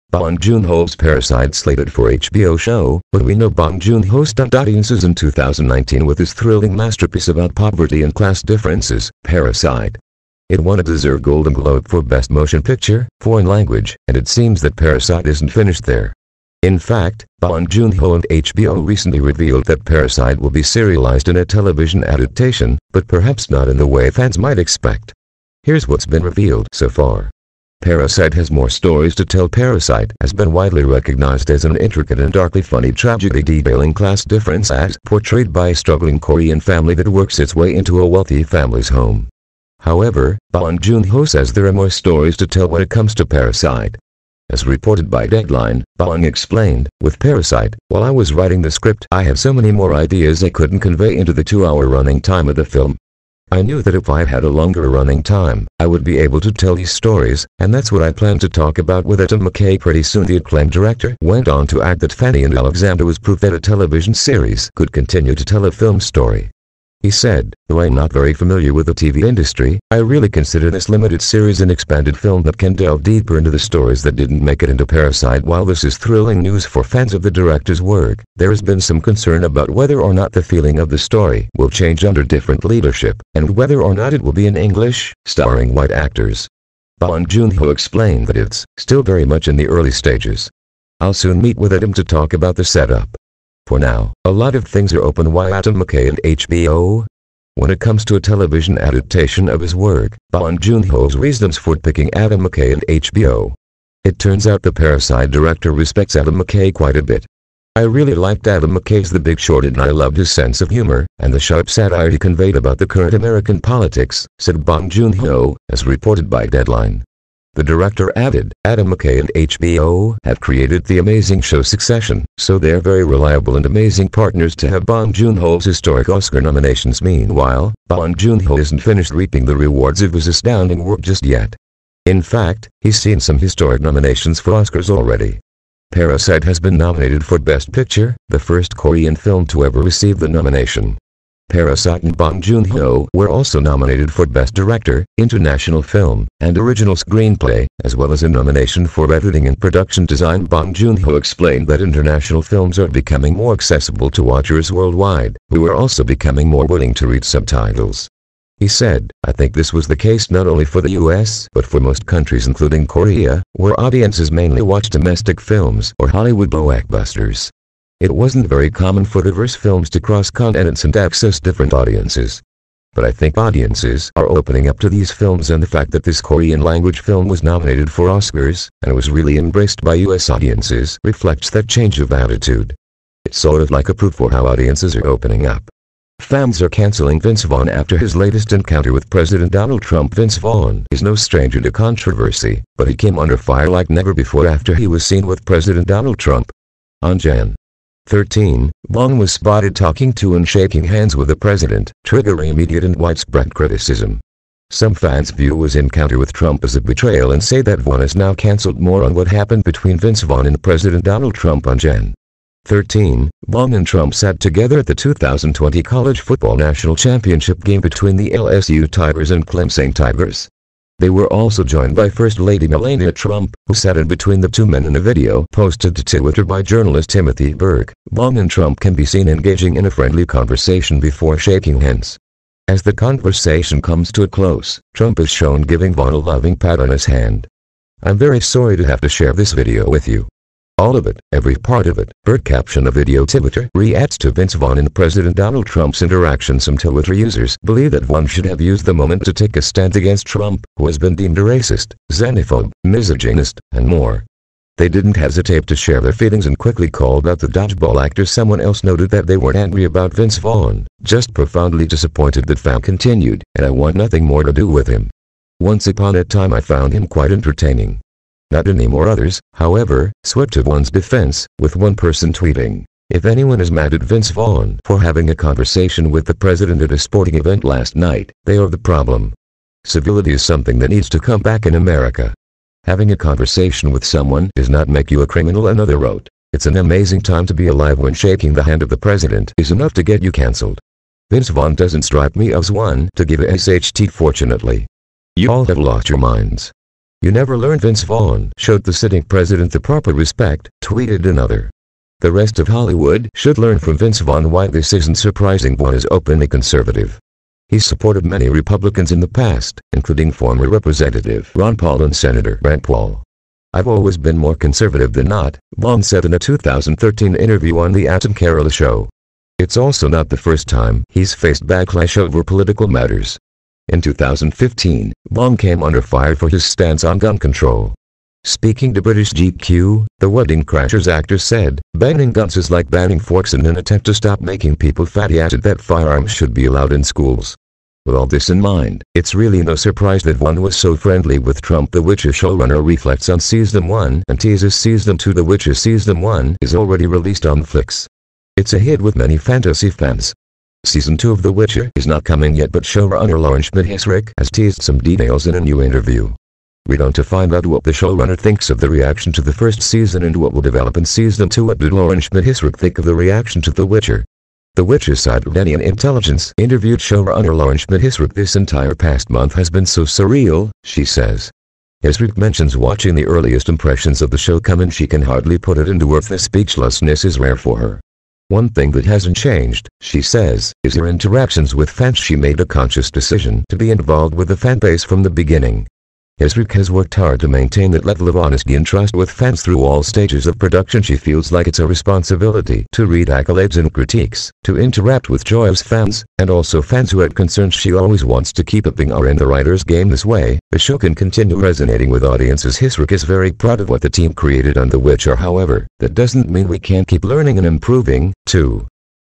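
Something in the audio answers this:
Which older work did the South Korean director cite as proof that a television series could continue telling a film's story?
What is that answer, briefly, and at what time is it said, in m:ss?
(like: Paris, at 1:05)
Fanny and Alexander, at 1:02.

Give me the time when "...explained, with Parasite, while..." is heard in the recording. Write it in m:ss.
0:46.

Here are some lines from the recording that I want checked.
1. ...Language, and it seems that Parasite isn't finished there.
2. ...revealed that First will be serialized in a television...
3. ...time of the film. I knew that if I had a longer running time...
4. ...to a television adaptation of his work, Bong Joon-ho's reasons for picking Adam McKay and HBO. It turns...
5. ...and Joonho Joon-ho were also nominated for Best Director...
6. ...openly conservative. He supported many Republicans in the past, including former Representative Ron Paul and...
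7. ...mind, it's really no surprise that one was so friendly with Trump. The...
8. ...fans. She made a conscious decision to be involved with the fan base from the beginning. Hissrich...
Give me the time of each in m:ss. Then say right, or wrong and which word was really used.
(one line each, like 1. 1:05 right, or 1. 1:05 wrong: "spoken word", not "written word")
1. 0:13 right
2. 0:19 wrong: "Parasite", not "First"
3. 0:52 right
4. 1:38 right
5. 2:22 wrong: "Bong", not "Joonho"
6. 5:06 right
7. 5:38 right
8. 6:21 right.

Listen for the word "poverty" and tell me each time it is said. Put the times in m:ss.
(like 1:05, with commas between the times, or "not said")
0:07.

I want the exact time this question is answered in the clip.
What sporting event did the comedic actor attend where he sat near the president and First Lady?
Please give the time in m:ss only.
3:35.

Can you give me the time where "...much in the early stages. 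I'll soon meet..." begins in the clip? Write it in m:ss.
1:29.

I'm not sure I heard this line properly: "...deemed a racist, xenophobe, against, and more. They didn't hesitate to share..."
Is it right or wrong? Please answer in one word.
wrong.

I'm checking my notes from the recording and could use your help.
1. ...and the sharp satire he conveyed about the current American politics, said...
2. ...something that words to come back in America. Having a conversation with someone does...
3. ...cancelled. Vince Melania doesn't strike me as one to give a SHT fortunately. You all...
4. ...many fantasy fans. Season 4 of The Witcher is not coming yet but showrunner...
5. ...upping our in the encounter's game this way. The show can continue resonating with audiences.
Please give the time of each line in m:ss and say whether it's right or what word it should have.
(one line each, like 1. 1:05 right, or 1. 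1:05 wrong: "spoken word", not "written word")
1. 1:51 right
2. 4:40 wrong: "needs", not "words"
3. 4:50 wrong: "Vaughn", not "Melania"
4. 5:49 wrong: "2", not "4"
5. 6:38 wrong: "writer", not "encounter".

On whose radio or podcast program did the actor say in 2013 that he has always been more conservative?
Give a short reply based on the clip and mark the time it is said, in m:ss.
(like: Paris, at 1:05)
The Adam Carolla Show, at 5:17.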